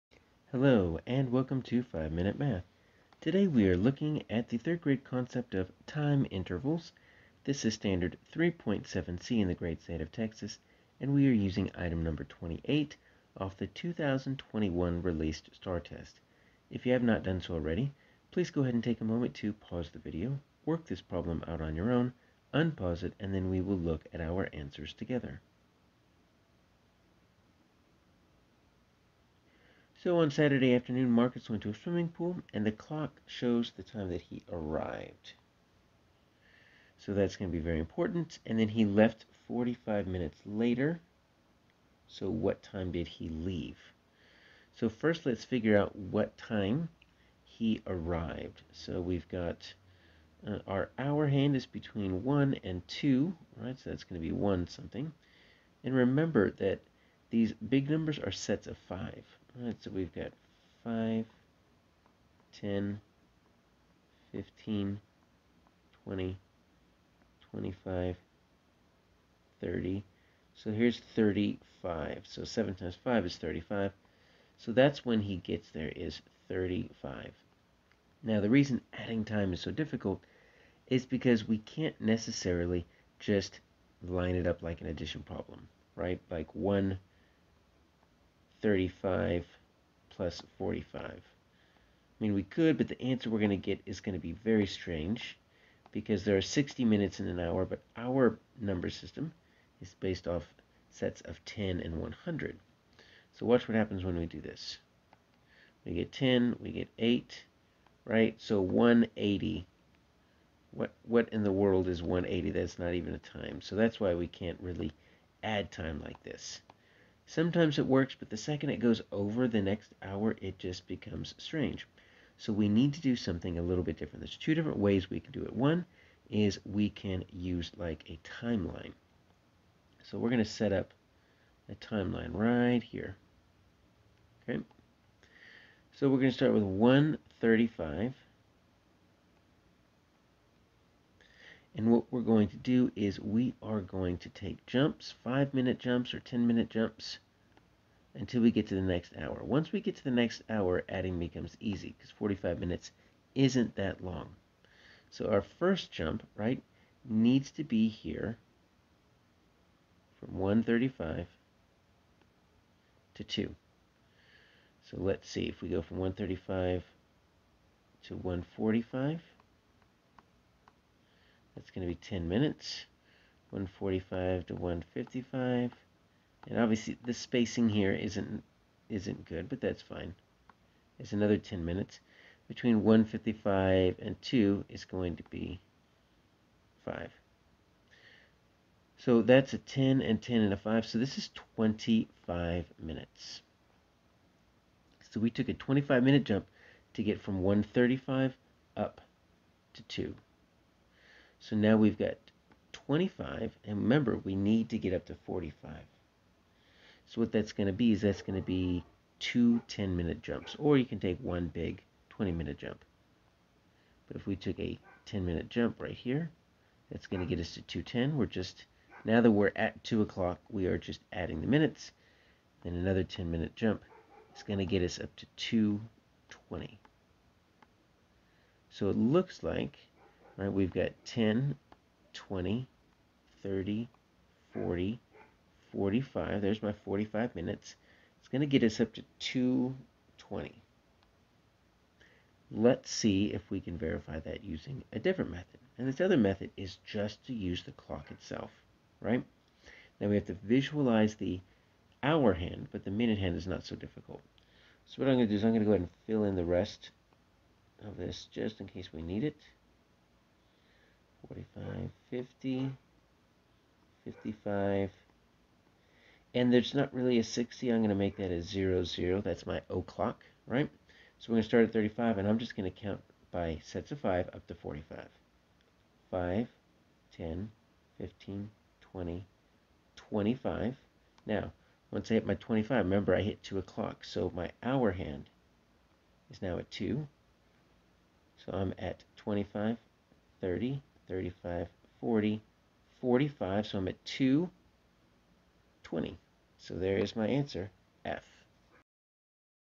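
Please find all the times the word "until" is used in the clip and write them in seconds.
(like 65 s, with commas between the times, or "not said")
148 s.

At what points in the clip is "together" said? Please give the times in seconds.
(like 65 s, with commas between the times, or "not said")
24 s.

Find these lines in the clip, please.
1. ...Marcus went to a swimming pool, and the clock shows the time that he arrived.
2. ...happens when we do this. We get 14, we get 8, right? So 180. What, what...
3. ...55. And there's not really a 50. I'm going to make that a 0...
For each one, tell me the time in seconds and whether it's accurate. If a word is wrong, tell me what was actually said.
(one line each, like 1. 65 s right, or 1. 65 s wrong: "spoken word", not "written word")
1. 31 s right
2. 103 s wrong: "10", not "14"
3. 264 s wrong: "60", not "50".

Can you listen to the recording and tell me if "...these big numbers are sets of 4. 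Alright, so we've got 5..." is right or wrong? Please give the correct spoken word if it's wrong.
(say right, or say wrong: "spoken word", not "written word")
wrong: "5", not "4".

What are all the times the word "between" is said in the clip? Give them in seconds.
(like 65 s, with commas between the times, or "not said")
51 s, 182 s.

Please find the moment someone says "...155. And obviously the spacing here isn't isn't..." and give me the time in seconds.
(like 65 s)
174 s.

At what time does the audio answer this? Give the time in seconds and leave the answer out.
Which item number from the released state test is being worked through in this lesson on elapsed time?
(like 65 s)
11 s.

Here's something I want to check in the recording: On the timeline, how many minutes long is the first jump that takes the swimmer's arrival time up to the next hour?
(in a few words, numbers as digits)
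25 minutes.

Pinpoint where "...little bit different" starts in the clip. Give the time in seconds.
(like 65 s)
123 s.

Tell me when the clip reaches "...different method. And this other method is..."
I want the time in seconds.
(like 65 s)
244 s.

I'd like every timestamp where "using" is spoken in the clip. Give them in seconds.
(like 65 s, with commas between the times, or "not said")
11 s, 244 s.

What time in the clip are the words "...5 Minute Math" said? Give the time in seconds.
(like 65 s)
1 s.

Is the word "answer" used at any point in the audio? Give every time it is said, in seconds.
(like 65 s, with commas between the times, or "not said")
24 s, 93 s, 297 s.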